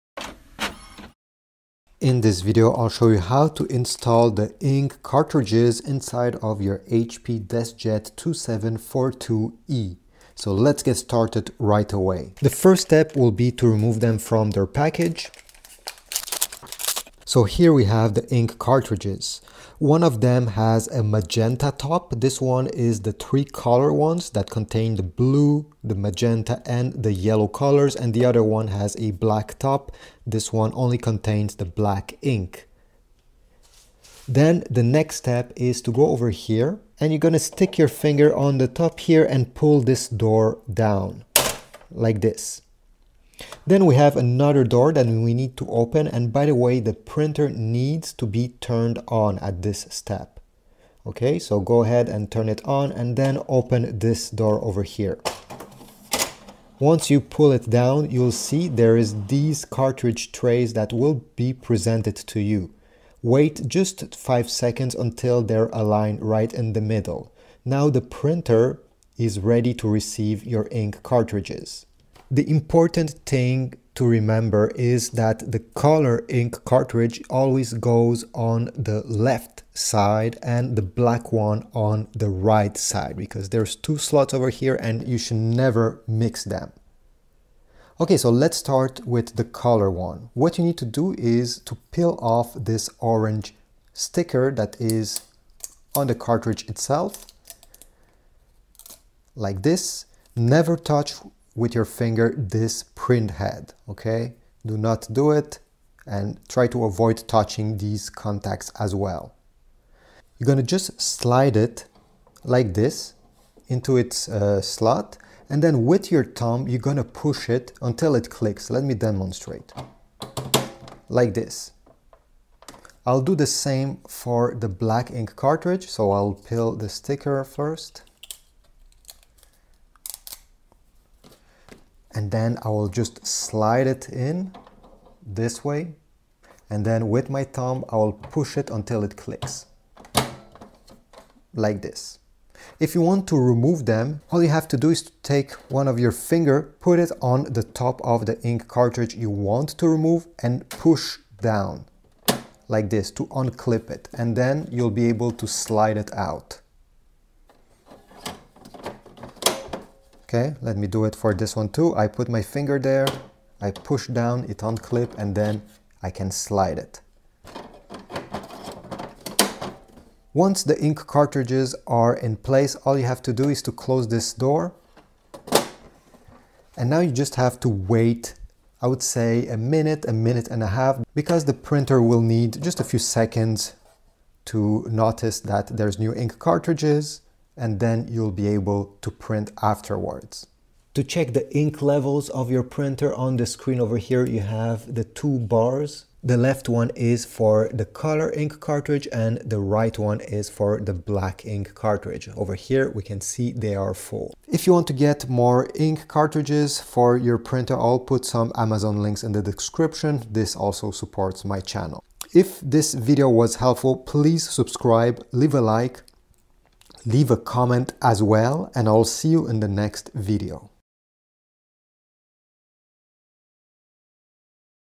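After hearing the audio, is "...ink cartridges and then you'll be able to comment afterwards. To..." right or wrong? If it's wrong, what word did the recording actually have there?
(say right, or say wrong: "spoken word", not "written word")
wrong: "print", not "comment".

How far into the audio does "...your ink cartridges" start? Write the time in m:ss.
1:10.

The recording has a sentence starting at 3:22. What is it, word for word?
Over here, we can see they are full.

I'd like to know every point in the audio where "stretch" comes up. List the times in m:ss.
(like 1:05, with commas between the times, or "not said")
not said.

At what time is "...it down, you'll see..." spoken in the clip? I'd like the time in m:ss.
0:57.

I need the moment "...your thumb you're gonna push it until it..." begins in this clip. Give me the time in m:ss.
1:56.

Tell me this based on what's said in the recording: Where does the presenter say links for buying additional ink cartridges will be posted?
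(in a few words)
In the description.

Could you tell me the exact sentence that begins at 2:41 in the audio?
I put my finger there, I push down, it unclip, and then I can slide it.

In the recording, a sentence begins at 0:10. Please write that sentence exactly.
So let's get started right away.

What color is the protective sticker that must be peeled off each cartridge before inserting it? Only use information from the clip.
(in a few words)
Orange.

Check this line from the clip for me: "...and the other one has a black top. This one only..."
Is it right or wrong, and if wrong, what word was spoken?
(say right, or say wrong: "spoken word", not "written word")
right.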